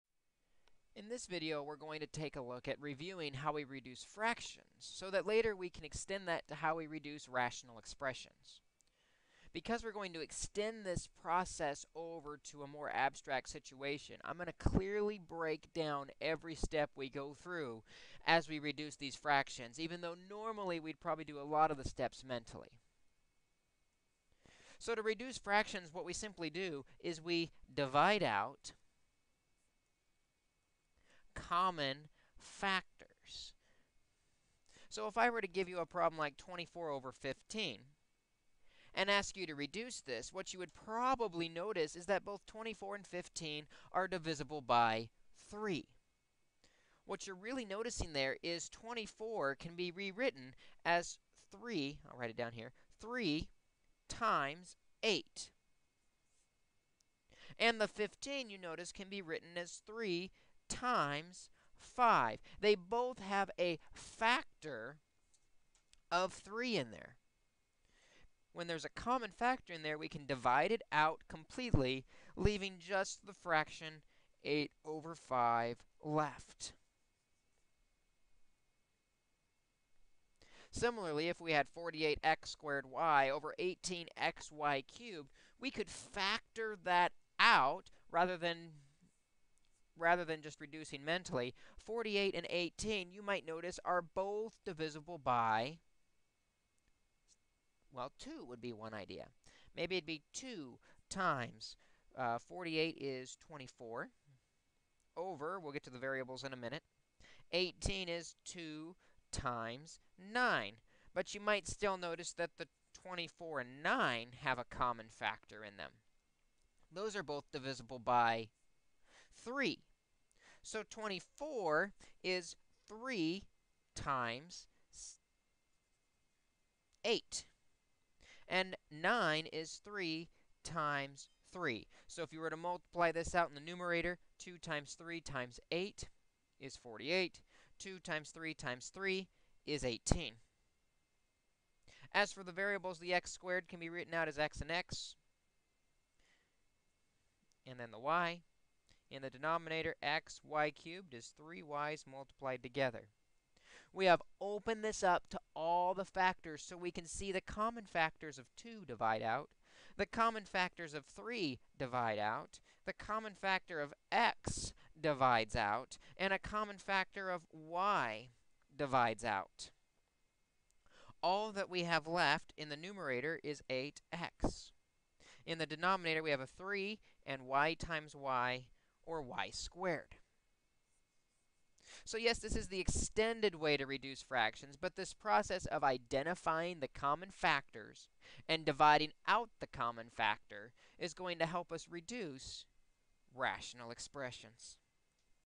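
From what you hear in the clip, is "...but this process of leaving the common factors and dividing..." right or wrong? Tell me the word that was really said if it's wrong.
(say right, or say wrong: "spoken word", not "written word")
wrong: "identifying", not "leaving".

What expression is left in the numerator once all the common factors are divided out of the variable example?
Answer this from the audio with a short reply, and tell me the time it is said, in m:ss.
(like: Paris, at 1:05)
8x, at 2:53.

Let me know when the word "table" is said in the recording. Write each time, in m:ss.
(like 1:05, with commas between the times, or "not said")
not said.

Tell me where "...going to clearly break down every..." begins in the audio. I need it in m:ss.
0:14.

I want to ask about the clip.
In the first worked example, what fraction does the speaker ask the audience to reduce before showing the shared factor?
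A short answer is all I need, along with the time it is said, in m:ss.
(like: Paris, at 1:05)
24/15, at 0:36.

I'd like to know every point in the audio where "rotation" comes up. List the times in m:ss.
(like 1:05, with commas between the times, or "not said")
not said.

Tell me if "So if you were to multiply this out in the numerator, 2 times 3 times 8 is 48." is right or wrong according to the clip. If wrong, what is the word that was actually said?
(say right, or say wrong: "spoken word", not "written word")
right.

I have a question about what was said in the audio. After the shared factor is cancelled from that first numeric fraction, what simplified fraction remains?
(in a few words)
8/5.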